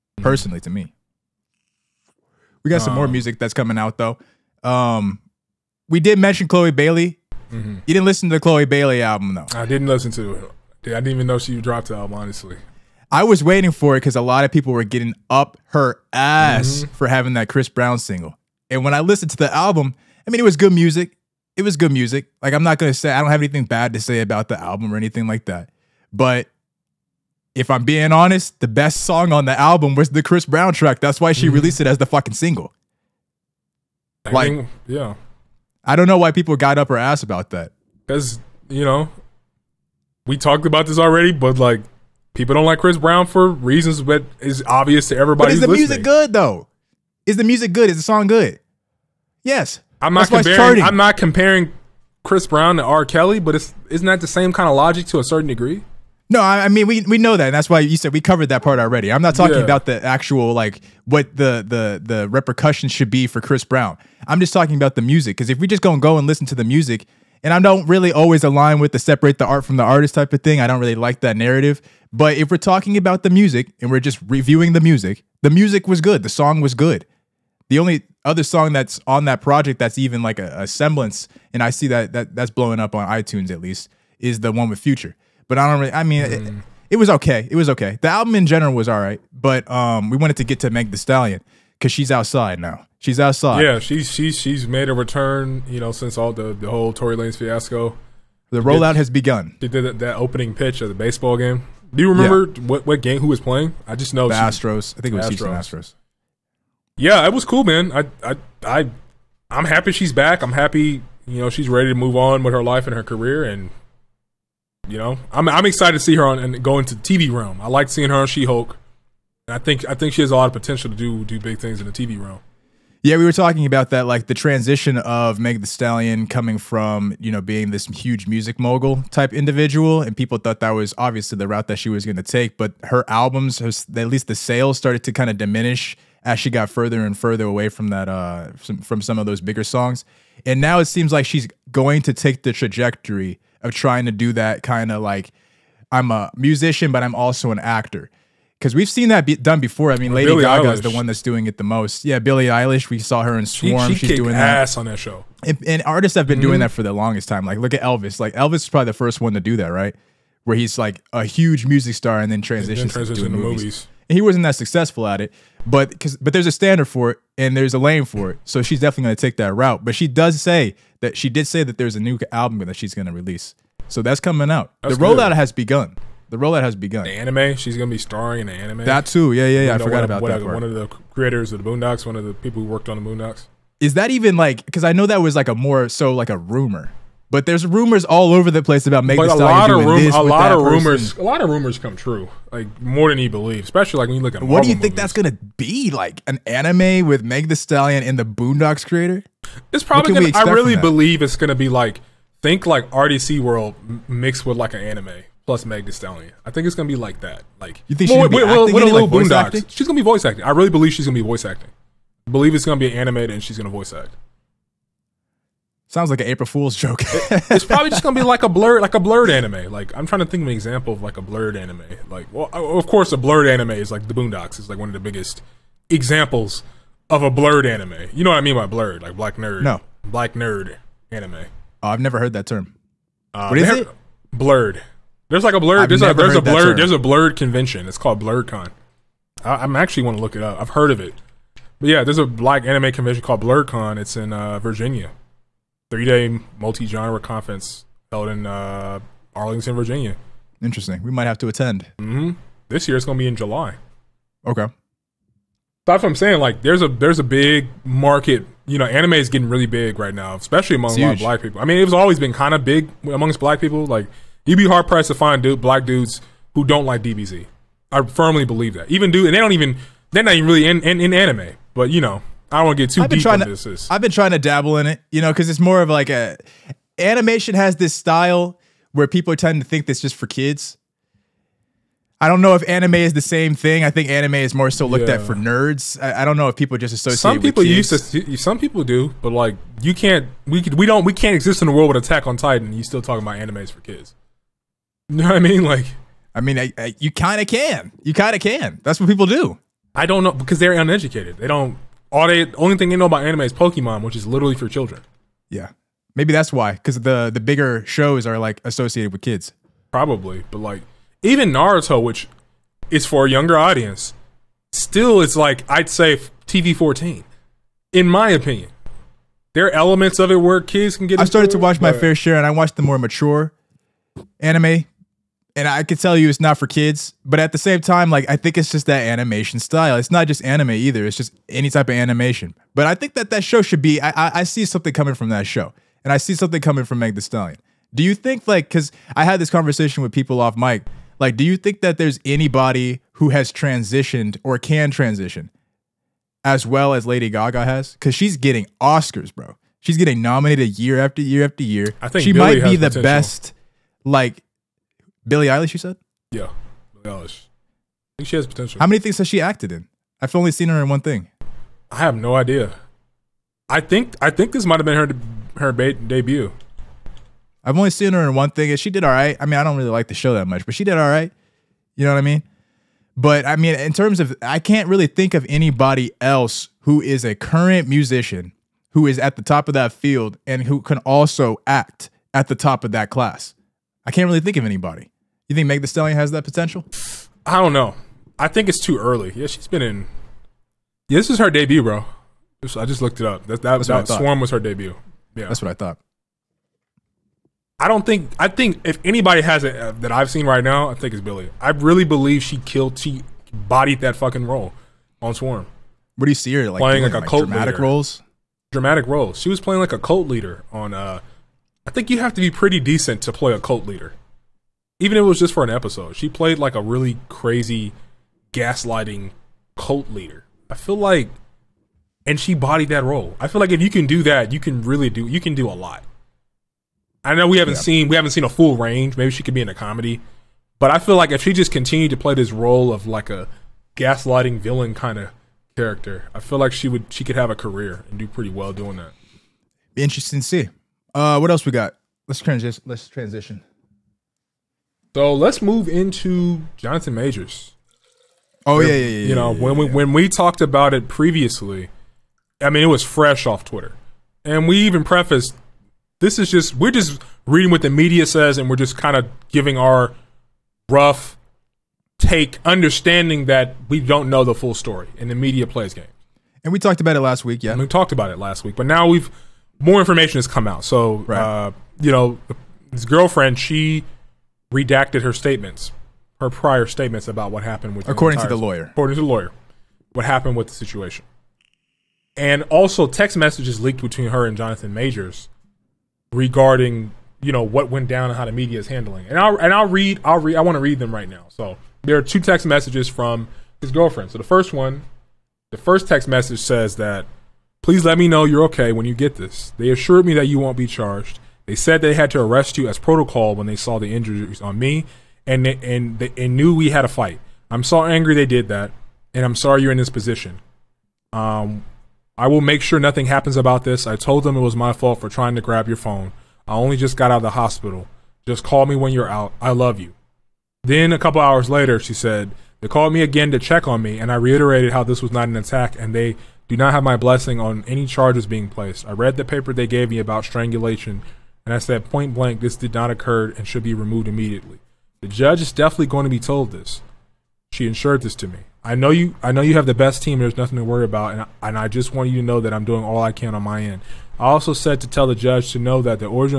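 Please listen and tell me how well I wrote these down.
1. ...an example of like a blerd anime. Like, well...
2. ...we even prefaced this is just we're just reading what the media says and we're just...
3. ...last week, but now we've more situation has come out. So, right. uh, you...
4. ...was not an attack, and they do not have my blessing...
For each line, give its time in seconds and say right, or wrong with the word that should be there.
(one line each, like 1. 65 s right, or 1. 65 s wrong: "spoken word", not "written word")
1. 220 s right
2. 454 s right
3. 468 s wrong: "information", not "situation"
4. 525 s right.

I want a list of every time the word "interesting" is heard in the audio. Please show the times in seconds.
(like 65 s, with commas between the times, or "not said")
250 s, 440 s.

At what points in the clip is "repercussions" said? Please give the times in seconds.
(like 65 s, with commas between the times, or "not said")
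62 s.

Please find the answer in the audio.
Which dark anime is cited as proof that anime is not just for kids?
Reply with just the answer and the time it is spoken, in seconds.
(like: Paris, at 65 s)
Attack on Titan, at 292 s.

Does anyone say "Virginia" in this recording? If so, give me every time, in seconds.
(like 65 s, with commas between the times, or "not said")
244 s, 249 s.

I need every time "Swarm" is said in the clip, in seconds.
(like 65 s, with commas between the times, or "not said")
153 s, 394 s, 405 s.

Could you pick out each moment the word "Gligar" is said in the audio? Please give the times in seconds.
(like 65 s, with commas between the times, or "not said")
not said.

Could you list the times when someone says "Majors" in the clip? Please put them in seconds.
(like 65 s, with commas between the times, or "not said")
447 s, 484 s.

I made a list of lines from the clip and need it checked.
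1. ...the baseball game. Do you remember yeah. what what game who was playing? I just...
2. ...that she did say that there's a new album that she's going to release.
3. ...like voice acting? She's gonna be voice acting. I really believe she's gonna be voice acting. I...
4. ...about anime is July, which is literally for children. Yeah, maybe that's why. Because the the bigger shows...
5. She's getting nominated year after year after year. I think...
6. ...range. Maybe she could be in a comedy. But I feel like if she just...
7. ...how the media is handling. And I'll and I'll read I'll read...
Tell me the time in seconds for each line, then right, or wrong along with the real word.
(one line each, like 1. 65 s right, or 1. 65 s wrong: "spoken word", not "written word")
1. 100 s right
2. 171 s right
3. 209 s right
4. 303 s wrong: "Pokemon", not "July"
5. 349 s right
6. 428 s right
7. 488 s right.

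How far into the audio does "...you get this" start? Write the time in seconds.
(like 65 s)
499 s.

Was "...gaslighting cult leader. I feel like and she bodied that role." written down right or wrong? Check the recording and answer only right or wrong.
right.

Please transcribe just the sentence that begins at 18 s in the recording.
And when I listened to the album, I mean, it was good music.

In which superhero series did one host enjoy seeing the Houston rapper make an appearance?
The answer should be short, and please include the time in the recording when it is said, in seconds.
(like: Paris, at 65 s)
She Hulk, at 118 s.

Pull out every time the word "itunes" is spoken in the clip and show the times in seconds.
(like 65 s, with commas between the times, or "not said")
83 s.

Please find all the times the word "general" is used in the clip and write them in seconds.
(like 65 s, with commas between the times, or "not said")
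88 s.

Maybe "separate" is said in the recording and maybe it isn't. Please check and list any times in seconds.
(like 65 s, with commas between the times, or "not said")
68 s.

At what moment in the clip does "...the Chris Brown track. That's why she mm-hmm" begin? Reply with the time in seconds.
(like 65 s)
30 s.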